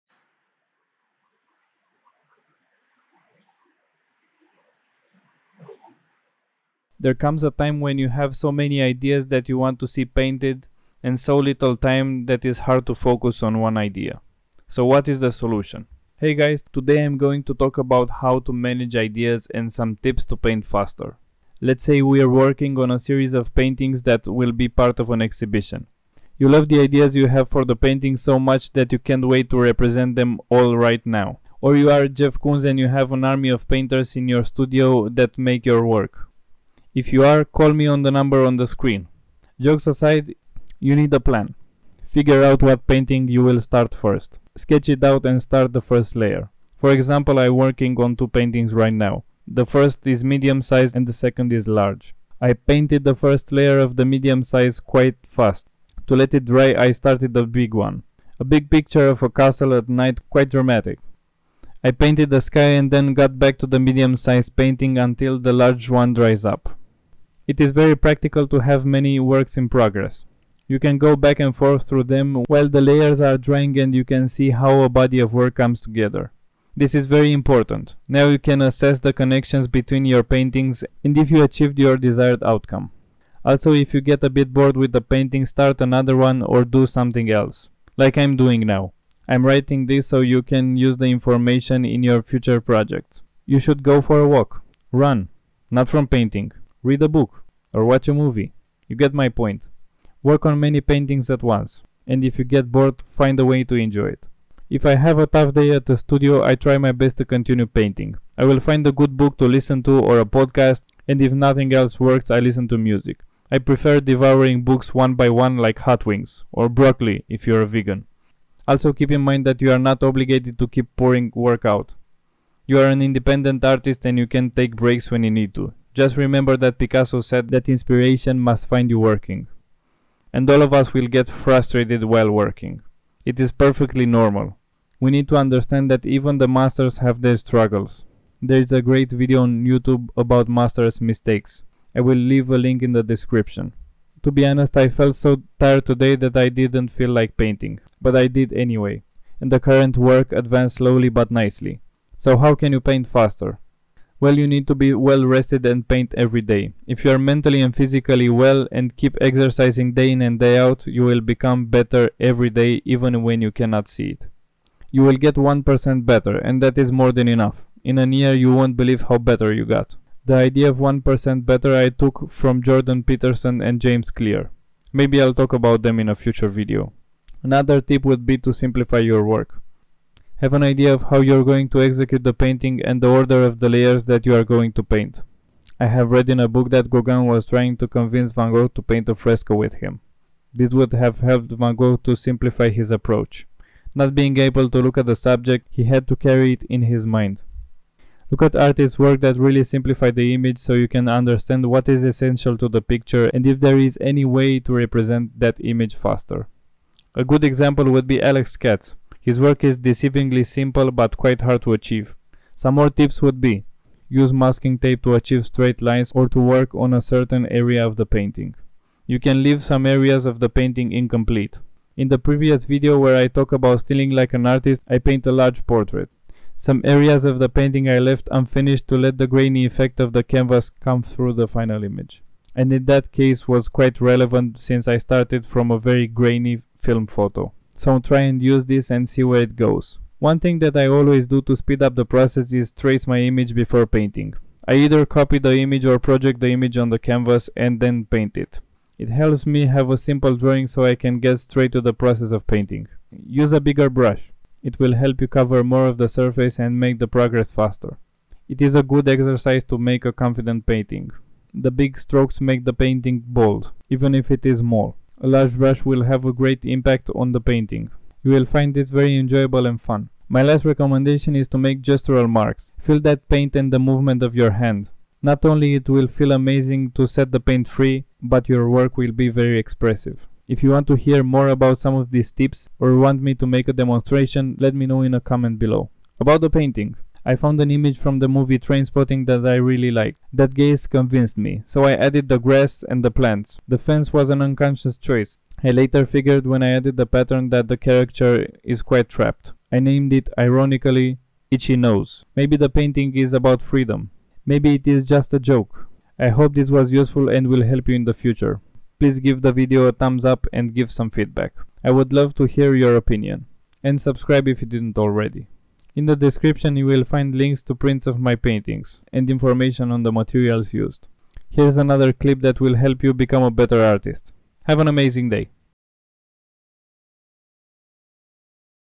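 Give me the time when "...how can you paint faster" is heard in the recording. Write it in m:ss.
2:32.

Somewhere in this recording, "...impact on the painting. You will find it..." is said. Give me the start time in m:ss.
4:26.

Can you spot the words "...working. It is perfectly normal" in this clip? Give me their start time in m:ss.
2:12.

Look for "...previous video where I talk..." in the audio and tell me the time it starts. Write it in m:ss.
3:42.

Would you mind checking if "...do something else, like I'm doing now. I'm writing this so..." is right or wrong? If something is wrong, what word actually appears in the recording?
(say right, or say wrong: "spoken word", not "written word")
right.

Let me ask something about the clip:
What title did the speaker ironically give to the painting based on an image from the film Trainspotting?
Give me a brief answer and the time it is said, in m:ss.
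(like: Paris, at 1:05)
Itchy Nose, at 5:01.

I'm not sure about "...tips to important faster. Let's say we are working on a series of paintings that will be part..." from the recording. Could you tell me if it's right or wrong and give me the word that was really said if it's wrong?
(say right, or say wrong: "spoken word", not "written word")
wrong: "paint", not "important".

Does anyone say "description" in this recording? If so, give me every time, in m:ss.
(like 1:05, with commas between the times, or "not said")
2:23, 5:16.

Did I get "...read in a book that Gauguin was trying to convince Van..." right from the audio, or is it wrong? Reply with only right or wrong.
right.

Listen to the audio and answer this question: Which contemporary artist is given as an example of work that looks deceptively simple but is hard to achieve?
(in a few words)
Alex Katz.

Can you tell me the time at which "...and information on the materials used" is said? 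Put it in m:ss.
5:19.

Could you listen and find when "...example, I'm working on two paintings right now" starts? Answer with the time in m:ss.
0:46.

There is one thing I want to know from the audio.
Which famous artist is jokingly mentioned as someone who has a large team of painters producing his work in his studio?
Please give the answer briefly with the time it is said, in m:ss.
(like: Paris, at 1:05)
Jeff Koons, at 0:32.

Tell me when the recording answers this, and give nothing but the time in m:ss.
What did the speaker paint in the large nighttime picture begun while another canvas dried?
0:59.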